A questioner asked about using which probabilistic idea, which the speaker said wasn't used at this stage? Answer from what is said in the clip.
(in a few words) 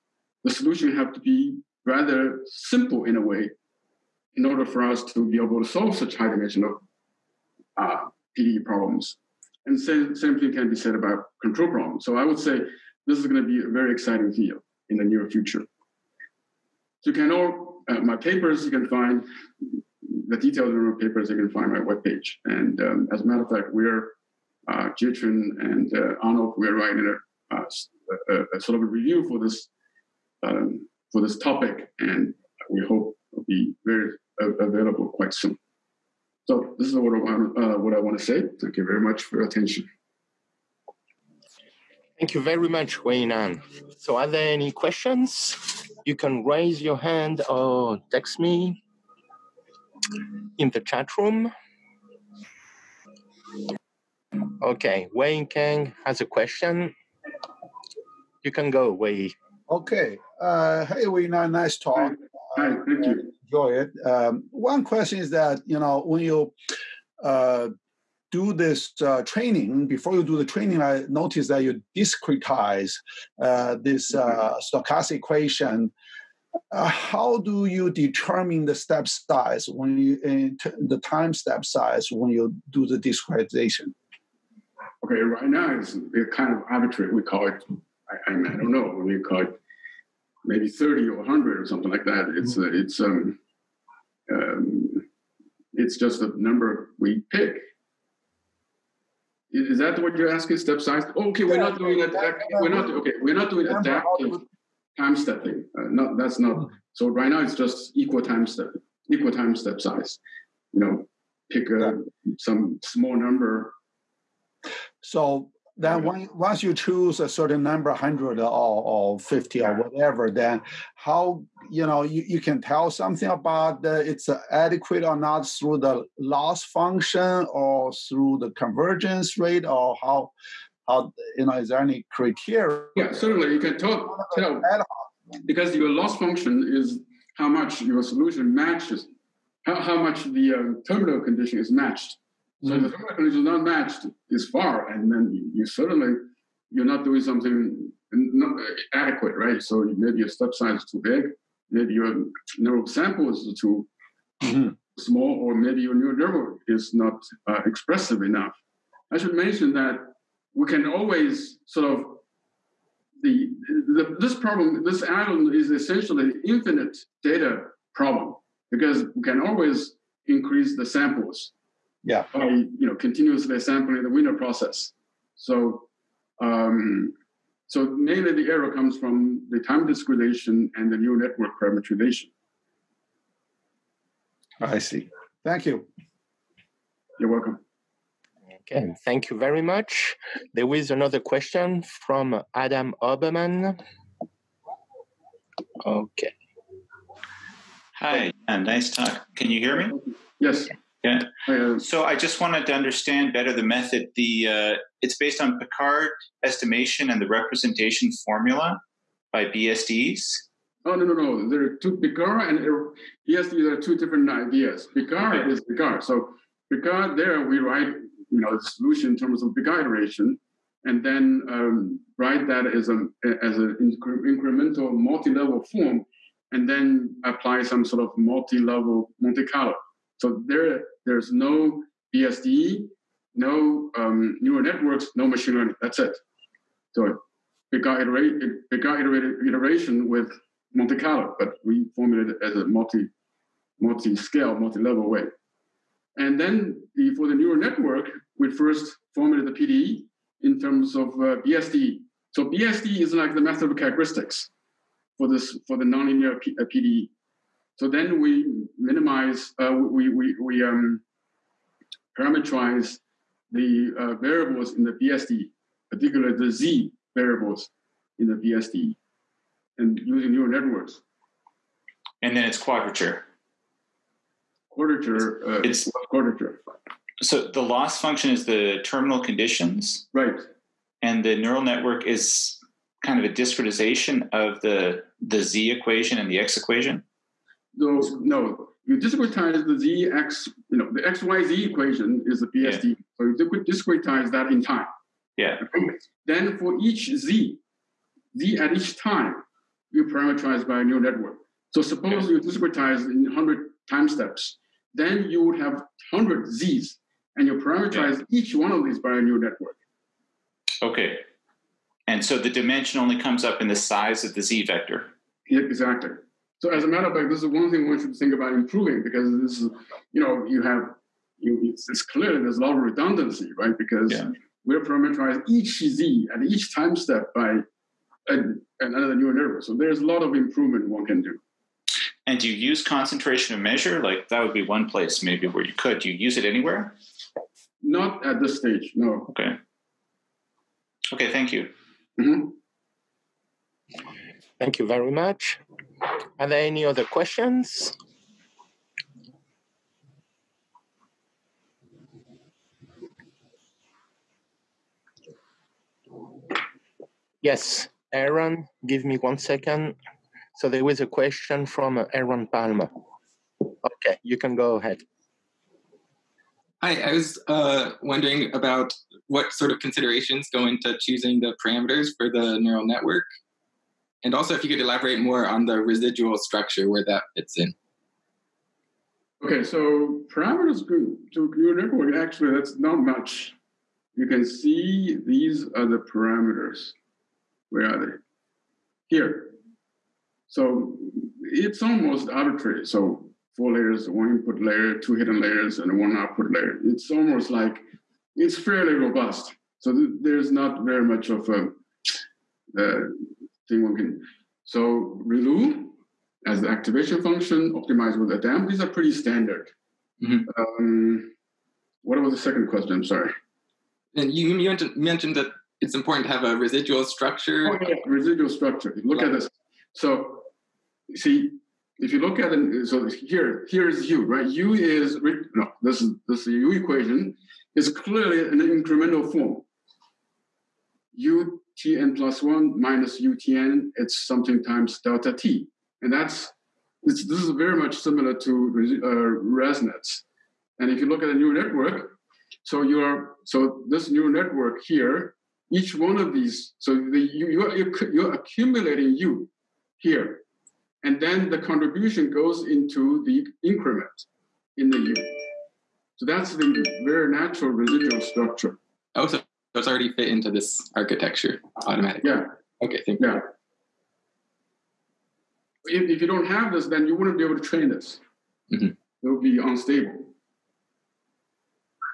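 Concentration of measure.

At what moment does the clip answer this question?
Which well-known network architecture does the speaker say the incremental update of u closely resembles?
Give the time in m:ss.
7:19.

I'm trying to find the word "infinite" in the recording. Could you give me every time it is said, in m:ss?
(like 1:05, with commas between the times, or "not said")
2:46.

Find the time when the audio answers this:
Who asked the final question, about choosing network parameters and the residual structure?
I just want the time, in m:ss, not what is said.
6:02.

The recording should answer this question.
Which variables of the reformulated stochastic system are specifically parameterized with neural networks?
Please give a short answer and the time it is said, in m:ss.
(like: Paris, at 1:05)
Z variables, at 4:26.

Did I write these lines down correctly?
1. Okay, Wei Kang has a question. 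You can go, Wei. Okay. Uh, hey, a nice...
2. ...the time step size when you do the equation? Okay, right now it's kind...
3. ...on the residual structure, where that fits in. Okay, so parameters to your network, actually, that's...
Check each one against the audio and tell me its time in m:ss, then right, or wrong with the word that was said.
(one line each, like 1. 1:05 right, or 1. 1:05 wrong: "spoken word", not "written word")
1. 0:54 right
2. 1:20 wrong: "discretization", not "equation"
3. 6:15 right.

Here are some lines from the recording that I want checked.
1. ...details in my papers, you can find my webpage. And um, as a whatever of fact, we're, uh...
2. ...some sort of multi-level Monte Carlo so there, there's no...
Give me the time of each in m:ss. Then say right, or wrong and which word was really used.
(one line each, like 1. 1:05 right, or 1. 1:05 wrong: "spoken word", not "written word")
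1. 0:20 wrong: "matter", not "whatever"
2. 3:47 right.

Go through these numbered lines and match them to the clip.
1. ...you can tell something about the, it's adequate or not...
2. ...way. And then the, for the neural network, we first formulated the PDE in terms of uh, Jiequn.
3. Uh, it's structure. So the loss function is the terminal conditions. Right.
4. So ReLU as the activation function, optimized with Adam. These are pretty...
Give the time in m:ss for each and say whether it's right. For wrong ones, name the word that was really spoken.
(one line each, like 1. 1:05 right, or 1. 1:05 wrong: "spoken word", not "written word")
1. 2:02 right
2. 4:05 wrong: "BSDE", not "Jiequn"
3. 4:35 wrong: "quadrature", not "structure"
4. 6:44 right.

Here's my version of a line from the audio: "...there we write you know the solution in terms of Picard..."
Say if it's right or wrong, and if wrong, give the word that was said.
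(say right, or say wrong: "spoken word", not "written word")
right.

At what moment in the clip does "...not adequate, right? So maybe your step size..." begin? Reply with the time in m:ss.
2:28.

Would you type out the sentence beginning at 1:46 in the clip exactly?
So right now it's just equal time step, equal time step size.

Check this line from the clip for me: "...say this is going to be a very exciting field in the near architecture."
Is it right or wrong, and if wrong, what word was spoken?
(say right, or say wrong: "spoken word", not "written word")
wrong: "future", not "architecture".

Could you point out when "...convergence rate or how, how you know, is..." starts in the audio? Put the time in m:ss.
2:08.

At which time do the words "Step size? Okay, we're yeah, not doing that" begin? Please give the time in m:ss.
1:40.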